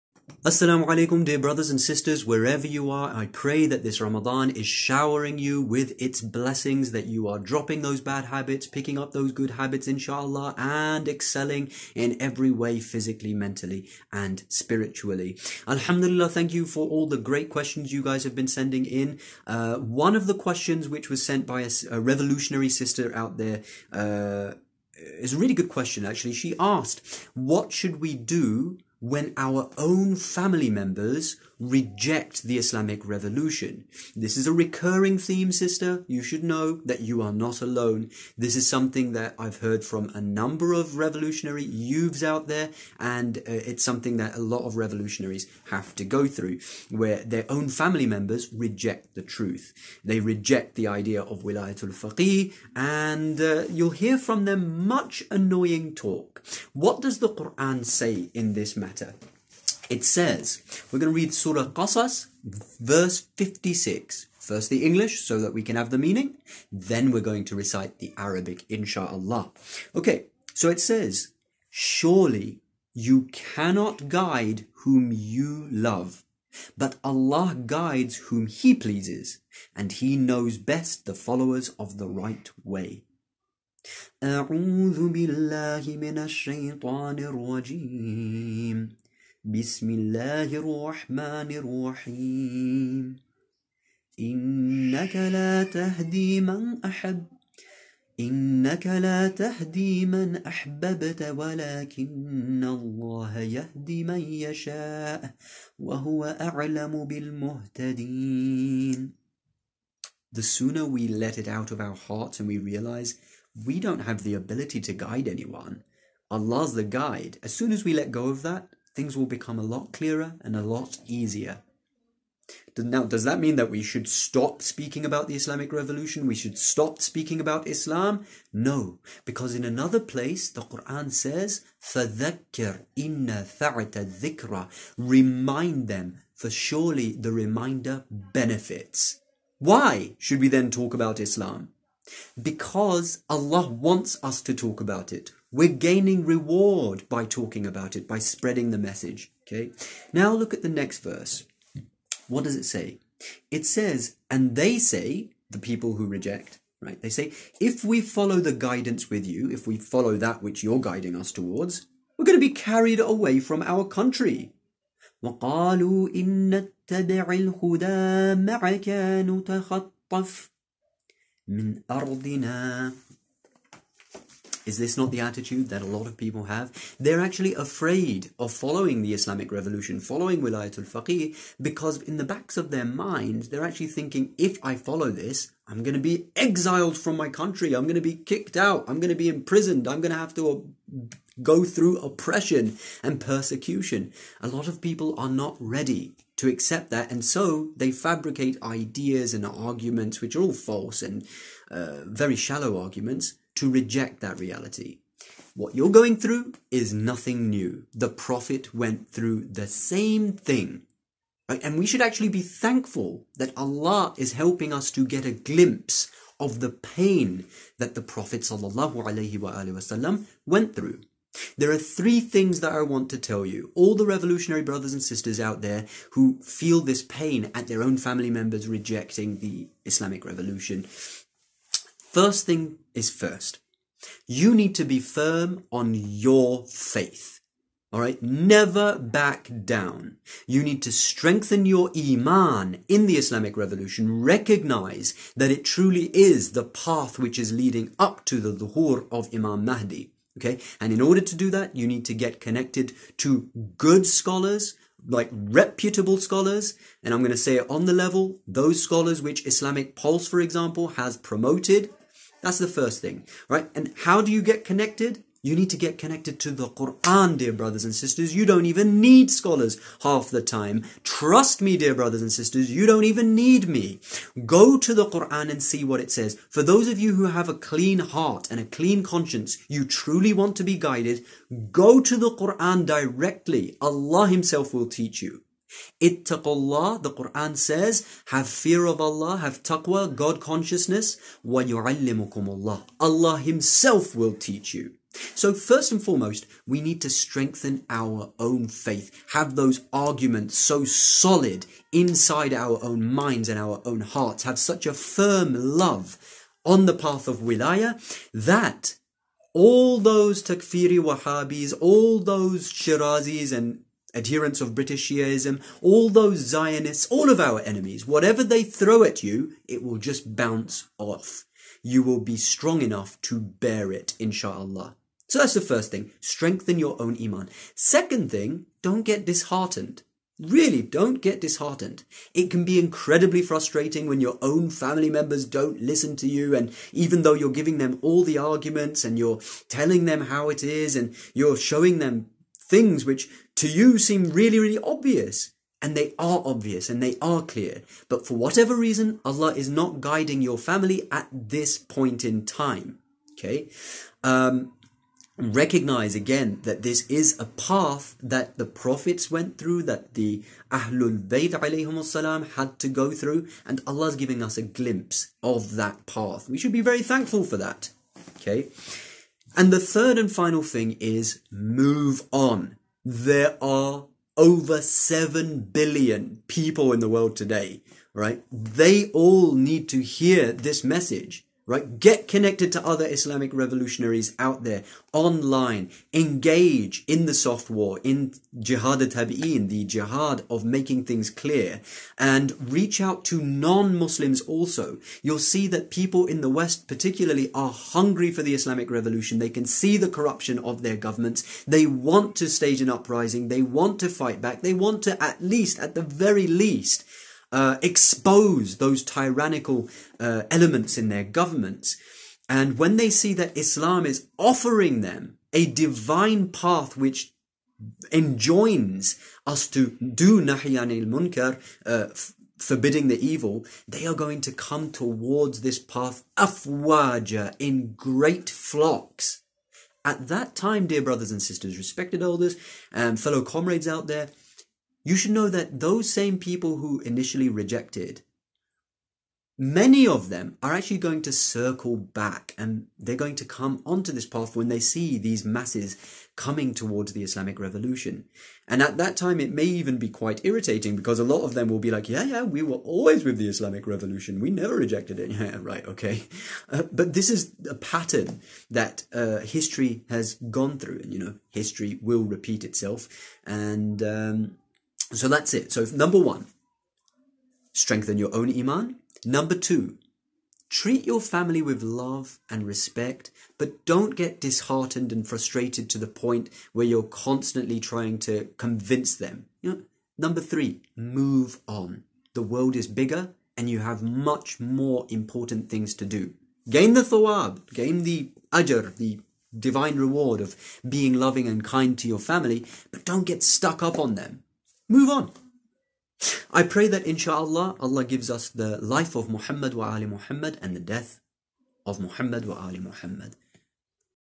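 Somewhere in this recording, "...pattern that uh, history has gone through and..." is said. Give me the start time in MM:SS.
07:37.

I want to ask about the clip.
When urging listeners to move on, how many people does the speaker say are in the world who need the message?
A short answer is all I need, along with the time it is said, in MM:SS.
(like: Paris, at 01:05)
over 7 billion, at 06:14.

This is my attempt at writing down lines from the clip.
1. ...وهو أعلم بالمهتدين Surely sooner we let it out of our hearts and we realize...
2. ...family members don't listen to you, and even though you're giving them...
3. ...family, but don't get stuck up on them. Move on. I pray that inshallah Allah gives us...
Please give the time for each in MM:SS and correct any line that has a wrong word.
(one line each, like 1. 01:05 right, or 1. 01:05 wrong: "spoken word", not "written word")
1. 01:45 wrong: "The", not "Surely"
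2. 05:34 right
3. 08:12 right.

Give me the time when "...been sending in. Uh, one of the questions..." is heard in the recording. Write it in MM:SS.
00:18.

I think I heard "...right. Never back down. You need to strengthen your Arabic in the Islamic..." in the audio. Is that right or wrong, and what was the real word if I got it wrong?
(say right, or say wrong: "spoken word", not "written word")
wrong: "Iman", not "Arabic".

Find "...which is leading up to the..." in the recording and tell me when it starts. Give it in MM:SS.
04:07.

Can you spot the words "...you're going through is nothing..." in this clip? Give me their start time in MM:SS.
03:25.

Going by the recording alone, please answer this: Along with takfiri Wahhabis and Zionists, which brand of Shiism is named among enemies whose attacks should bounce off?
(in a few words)
British Shiaism.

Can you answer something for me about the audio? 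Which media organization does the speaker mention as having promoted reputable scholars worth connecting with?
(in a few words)
Islamic Pulse.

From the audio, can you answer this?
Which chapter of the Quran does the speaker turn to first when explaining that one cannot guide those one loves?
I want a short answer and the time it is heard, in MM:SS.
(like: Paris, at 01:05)
Surah Qasas, at 01:01.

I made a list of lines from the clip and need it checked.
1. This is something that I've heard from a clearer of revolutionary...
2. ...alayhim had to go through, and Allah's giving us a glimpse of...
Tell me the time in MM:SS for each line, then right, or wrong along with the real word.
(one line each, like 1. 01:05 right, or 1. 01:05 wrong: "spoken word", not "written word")
1. 00:38 wrong: "number", not "clearer"
2. 06:01 right.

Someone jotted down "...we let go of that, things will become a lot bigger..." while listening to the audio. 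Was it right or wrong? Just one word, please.
wrong.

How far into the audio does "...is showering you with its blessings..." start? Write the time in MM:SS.
00:04.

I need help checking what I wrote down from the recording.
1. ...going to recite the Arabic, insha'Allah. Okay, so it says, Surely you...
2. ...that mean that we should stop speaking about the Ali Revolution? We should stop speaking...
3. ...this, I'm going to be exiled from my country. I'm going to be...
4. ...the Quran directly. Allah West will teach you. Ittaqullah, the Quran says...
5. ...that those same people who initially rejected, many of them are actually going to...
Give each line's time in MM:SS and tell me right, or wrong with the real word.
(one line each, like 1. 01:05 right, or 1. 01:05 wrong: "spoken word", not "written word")
1. 01:07 right
2. 02:03 wrong: "Islamic", not "Ali"
3. 03:05 right
4. 04:42 wrong: "Himself", not "West"
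5. 07:15 right.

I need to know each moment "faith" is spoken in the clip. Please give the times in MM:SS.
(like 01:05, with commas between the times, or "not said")
03:56, 04:58.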